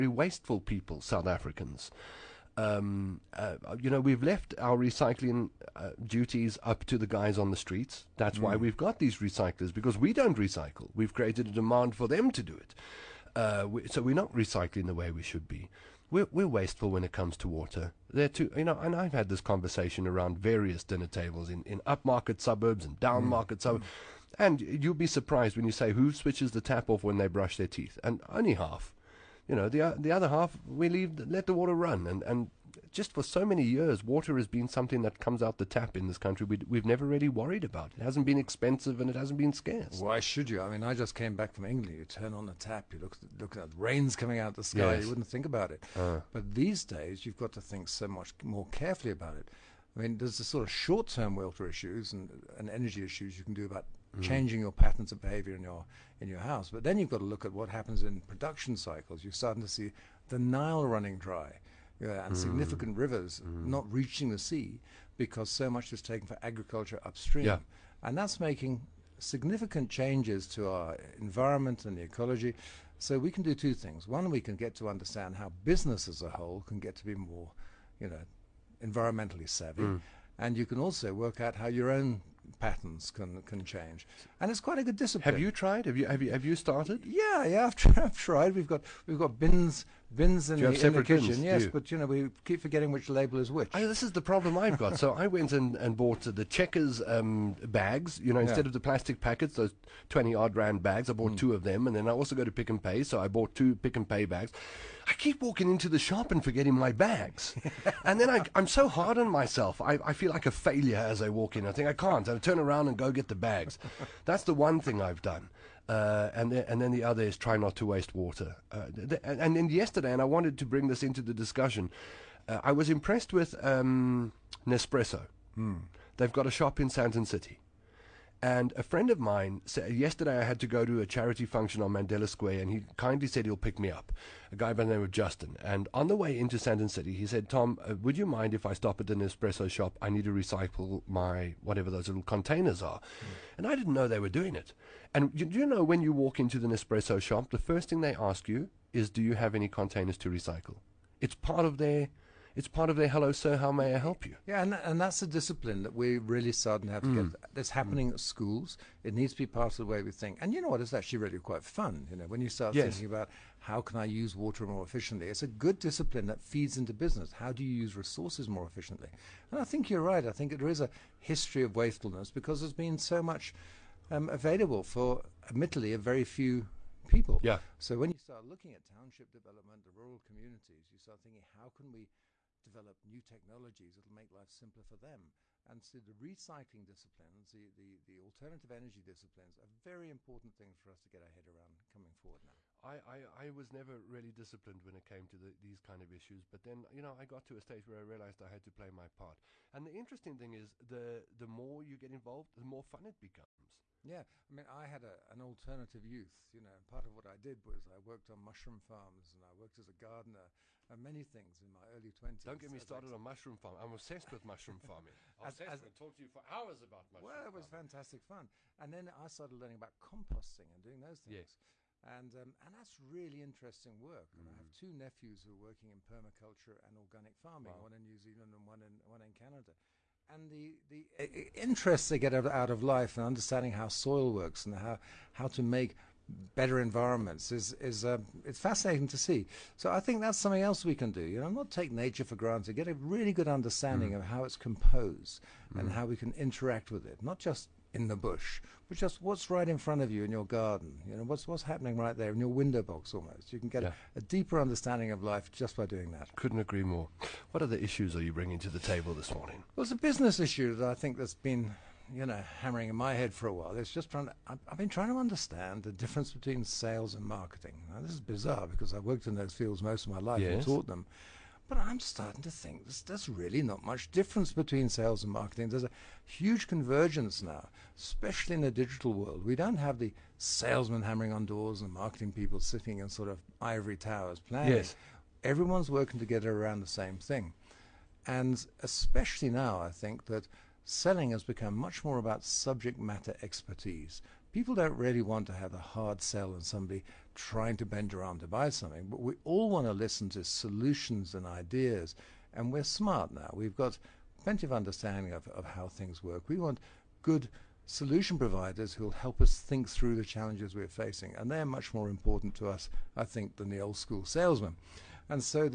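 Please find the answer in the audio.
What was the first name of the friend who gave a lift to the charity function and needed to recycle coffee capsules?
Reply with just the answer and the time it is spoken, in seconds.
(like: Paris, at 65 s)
Justin, at 135 s.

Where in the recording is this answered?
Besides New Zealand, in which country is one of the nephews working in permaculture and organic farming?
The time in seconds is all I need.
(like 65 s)
229 s.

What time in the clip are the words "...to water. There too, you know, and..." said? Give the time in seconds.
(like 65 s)
17 s.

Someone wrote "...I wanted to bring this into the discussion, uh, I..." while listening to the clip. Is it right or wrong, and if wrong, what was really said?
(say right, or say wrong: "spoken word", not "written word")
right.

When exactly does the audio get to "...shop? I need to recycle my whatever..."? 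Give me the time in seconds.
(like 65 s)
139 s.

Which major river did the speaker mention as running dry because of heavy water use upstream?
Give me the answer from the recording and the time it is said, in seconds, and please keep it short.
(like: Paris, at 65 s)
Nile, at 60 s.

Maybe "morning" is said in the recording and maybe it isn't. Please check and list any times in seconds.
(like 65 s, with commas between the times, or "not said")
259 s.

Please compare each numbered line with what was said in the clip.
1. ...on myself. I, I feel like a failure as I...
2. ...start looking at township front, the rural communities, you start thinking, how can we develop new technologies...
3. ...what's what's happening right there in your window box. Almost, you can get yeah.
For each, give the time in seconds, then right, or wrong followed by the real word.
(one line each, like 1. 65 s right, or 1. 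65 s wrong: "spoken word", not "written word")
1. 109 s right
2. 178 s wrong: "development", not "front"
3. 251 s right.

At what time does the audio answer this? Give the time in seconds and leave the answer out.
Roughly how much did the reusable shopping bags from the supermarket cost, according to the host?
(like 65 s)
100 s.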